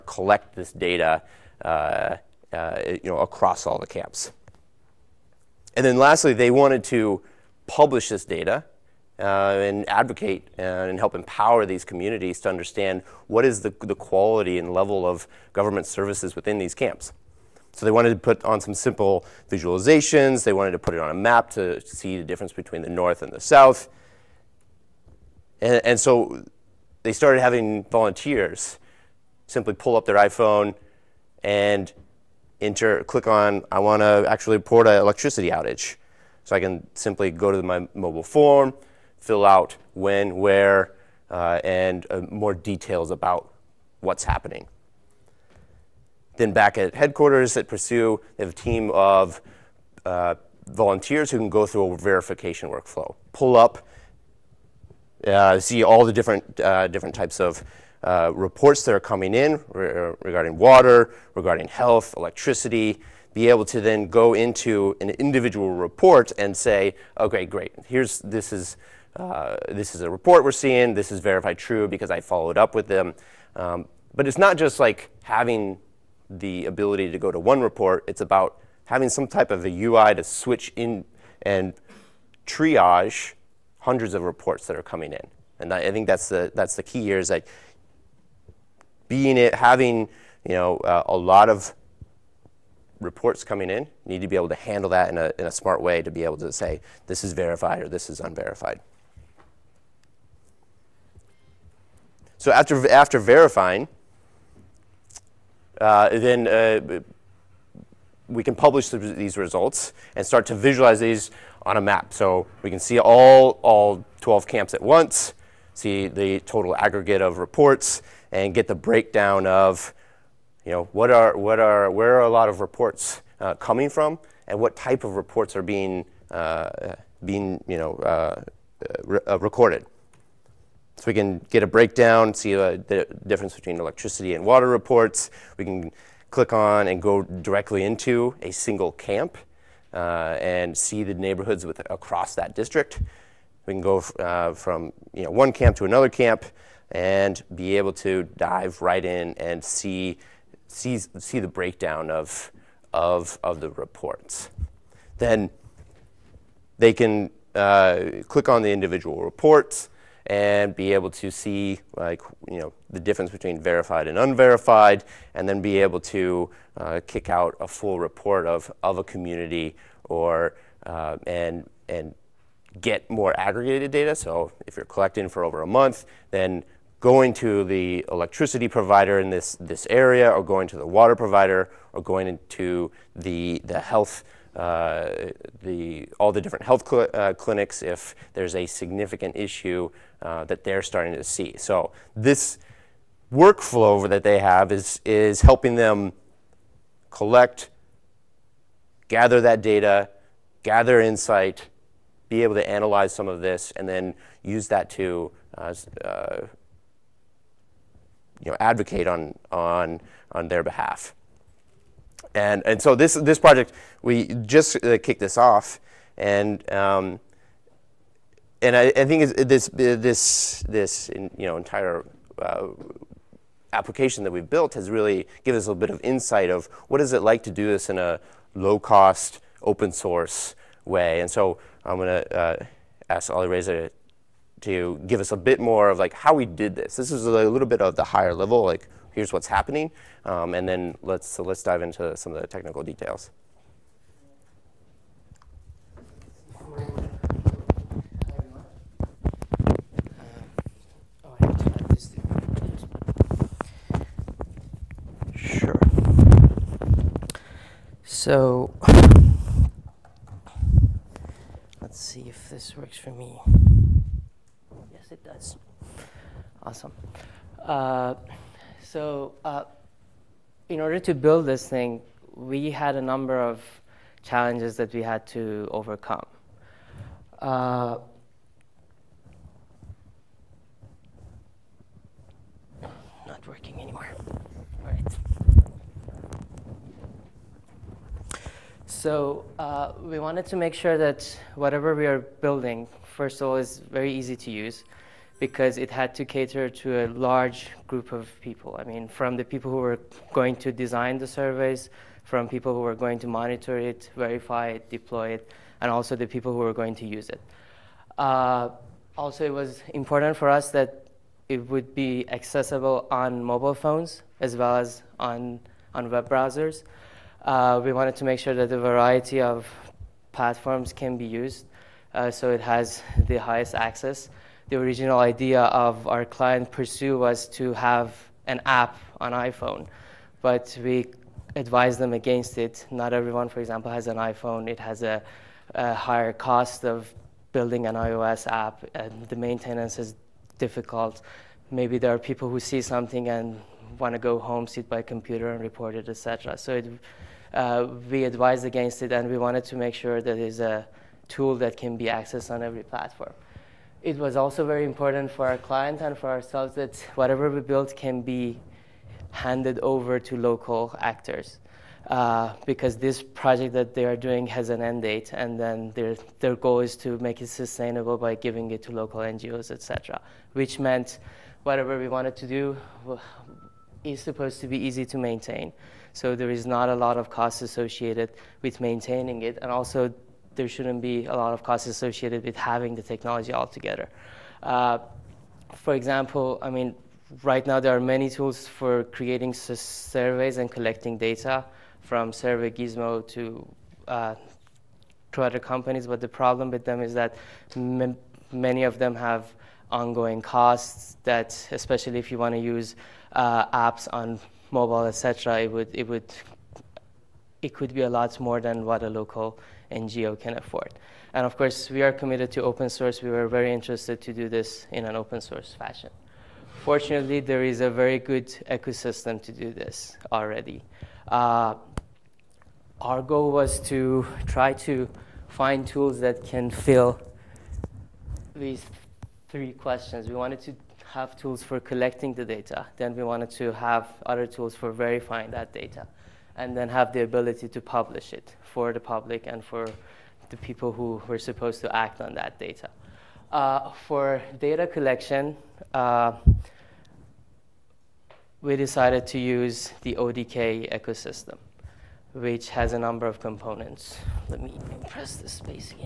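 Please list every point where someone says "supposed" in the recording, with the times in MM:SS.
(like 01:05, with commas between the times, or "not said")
06:14, 07:21.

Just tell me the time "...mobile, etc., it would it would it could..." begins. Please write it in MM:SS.
06:44.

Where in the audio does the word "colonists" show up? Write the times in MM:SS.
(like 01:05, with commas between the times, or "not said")
not said.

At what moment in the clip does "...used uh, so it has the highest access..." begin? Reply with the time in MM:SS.
05:21.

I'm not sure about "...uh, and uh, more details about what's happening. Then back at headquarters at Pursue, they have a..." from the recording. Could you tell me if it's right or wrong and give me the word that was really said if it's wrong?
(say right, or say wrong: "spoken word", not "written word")
right.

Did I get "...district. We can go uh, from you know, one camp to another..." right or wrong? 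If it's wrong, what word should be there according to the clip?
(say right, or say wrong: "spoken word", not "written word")
right.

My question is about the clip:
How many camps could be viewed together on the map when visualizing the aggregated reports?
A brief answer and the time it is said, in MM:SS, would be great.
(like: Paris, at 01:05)
12, at 01:54.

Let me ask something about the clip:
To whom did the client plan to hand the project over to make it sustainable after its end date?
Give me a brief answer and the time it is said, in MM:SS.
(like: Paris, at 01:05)
local NGOs, at 06:08.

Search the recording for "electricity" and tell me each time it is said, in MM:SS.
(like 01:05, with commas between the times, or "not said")
00:34, 01:02, 02:13, 02:58.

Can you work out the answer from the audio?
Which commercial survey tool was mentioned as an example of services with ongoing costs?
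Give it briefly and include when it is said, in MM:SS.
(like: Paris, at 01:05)
Survey Gizmo, at 06:32.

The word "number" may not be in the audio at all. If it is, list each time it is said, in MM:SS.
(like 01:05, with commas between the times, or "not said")
04:33, 07:32.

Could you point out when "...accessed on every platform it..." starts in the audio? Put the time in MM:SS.
05:52.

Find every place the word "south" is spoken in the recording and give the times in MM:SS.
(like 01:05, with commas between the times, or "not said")
00:23.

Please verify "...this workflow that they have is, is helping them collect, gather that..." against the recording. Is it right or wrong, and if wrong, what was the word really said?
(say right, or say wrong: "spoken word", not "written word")
right.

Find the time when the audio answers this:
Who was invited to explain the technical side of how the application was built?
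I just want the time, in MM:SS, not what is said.
03:53.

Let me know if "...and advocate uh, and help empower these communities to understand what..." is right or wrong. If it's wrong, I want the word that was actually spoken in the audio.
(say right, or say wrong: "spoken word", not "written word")
right.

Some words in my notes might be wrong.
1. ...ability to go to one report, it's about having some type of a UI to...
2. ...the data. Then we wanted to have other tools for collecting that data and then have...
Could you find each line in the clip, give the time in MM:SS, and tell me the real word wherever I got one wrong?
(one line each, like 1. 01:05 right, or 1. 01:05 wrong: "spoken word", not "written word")
1. 01:16 right
2. 07:12 wrong: "verifying", not "collecting".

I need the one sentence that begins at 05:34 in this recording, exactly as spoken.
It has a, a higher cost of building an iOS app, and the maintenance is difficult.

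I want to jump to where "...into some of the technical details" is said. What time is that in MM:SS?
04:01.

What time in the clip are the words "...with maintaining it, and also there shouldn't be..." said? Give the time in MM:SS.
06:18.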